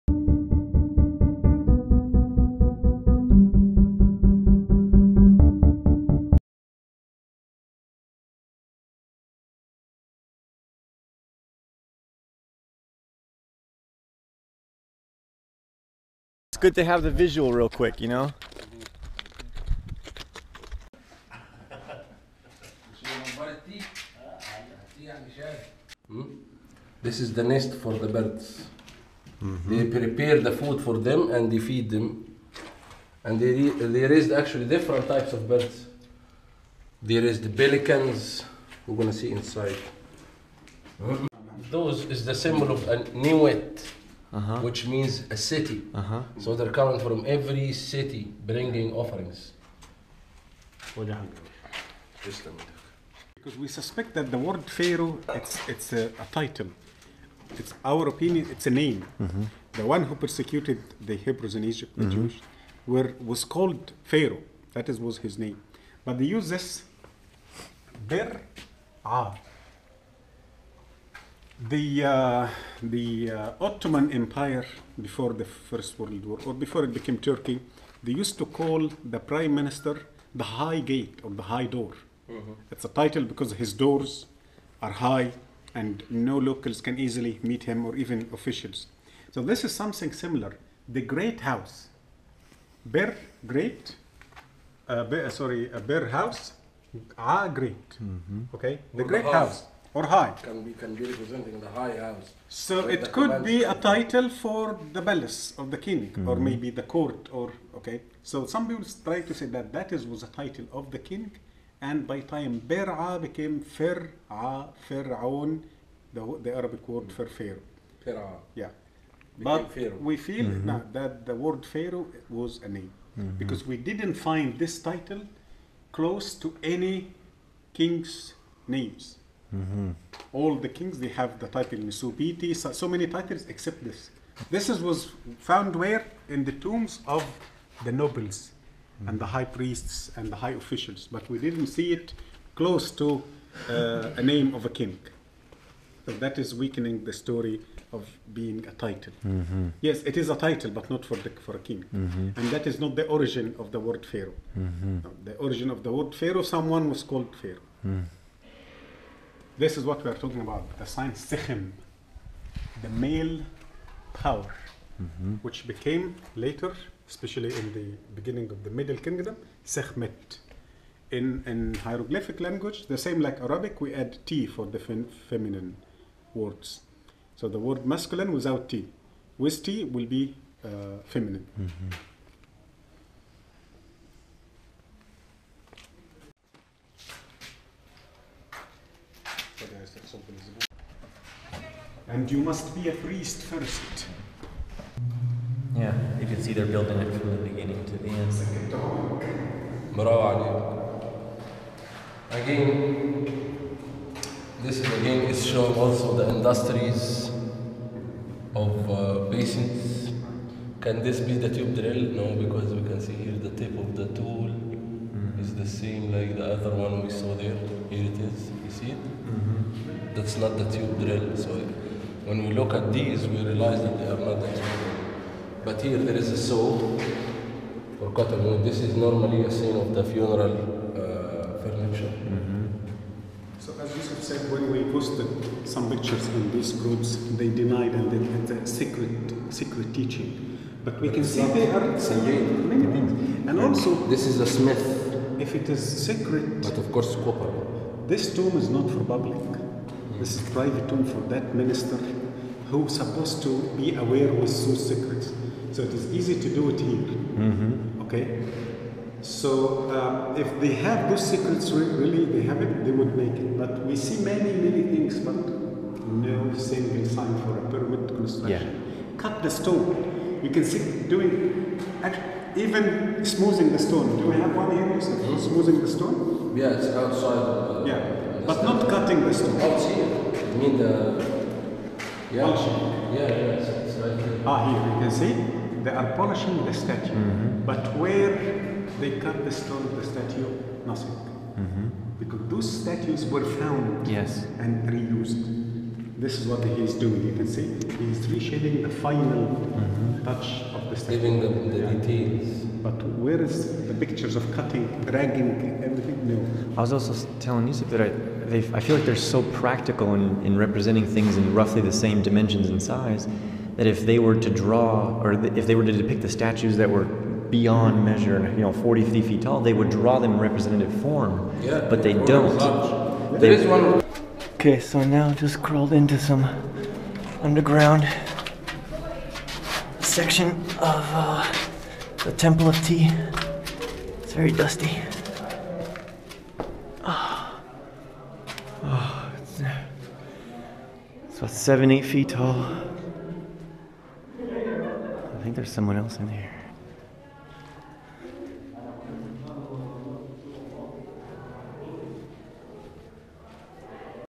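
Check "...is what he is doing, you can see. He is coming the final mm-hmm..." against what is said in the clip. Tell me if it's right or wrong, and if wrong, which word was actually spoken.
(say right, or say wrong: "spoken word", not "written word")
wrong: "reshaping", not "coming".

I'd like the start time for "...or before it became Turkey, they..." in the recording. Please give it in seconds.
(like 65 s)
76 s.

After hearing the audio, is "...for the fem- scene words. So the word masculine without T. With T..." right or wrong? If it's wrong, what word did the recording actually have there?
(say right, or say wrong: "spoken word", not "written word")
wrong: "feminine", not "scene".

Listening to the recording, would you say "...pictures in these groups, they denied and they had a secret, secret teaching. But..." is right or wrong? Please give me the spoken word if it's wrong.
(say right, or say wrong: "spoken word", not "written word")
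right.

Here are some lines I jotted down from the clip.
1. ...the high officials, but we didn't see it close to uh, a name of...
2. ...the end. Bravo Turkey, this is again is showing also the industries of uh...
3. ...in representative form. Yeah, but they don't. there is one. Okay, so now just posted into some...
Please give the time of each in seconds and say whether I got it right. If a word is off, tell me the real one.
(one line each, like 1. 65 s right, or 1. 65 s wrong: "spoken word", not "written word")
1. 140 s right
2. 197 s wrong: "Again", not "Turkey"
3. 320 s wrong: "crawled", not "posted".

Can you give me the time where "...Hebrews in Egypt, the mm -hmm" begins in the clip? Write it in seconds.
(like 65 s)
61 s.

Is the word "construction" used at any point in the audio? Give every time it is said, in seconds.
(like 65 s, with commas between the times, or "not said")
268 s.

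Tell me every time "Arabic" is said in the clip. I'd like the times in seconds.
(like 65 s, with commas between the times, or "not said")
116 s, 173 s.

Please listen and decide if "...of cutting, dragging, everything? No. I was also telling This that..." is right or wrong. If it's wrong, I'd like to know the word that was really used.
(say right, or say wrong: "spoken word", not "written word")
wrong: "Yousef", not "This".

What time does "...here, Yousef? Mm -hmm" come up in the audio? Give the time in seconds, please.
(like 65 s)
274 s.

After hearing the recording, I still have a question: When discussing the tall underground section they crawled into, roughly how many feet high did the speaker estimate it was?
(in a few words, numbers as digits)
7 to 8 feet.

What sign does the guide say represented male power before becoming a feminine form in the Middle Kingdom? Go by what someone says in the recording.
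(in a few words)
Sekhem.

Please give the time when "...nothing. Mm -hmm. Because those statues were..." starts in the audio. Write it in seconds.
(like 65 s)
290 s.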